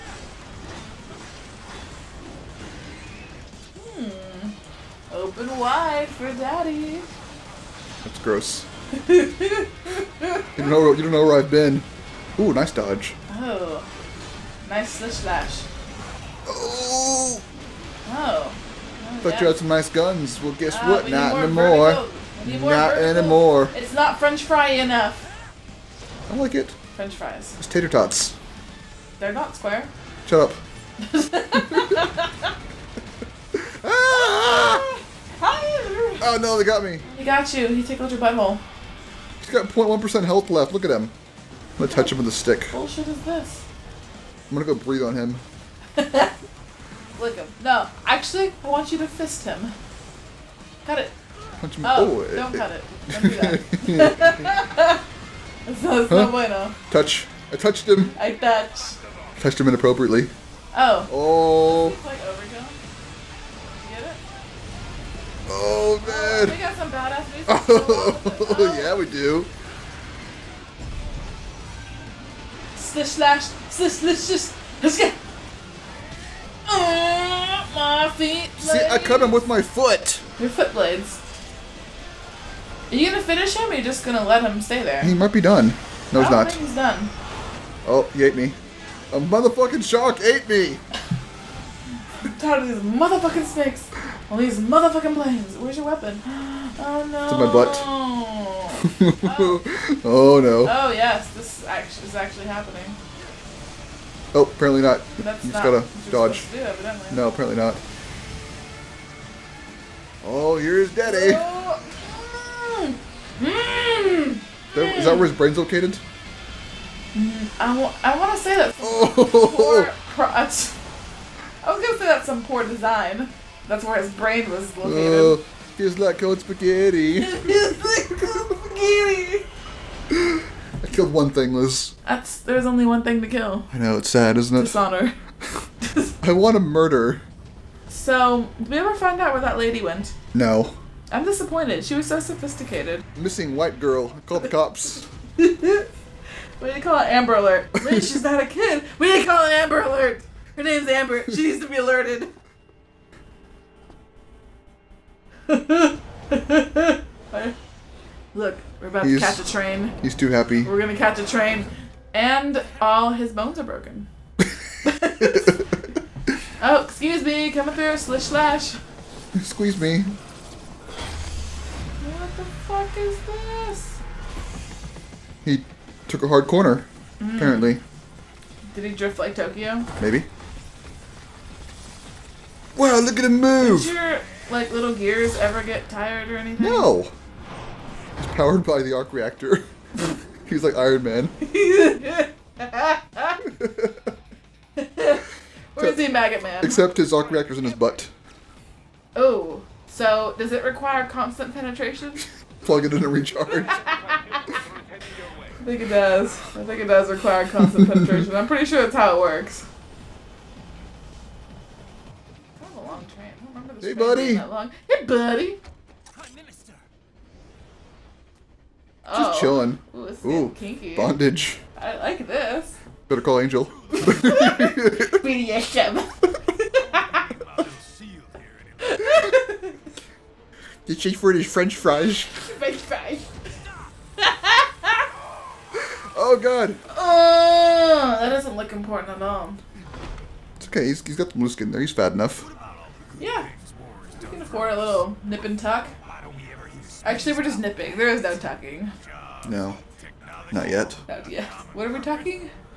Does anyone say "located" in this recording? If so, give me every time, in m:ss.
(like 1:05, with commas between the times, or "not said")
1:55, 2:04.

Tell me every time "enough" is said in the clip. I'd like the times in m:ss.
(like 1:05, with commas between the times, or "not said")
0:24, 4:02.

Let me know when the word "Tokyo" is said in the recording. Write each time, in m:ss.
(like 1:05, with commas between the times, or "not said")
2:59.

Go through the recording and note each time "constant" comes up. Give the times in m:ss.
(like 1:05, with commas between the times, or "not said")
3:21, 3:27.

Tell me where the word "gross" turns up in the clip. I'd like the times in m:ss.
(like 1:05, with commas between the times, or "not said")
0:08.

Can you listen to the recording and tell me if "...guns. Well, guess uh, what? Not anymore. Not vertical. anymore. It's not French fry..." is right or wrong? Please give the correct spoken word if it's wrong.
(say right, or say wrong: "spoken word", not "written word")
right.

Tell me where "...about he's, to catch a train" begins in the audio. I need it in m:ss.
2:38.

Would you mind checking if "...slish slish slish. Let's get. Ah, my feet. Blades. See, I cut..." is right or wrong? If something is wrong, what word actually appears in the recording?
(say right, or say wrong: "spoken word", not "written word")
right.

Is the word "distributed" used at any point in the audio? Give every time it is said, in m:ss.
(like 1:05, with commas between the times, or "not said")
not said.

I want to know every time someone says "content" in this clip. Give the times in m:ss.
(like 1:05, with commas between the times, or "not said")
not said.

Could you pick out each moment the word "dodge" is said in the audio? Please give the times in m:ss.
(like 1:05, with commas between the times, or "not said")
0:12, 1:46.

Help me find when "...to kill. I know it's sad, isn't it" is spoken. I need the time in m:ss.
2:13.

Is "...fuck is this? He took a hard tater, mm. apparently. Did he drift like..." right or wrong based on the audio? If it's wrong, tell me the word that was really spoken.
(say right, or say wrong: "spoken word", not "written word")
wrong: "corner", not "tater".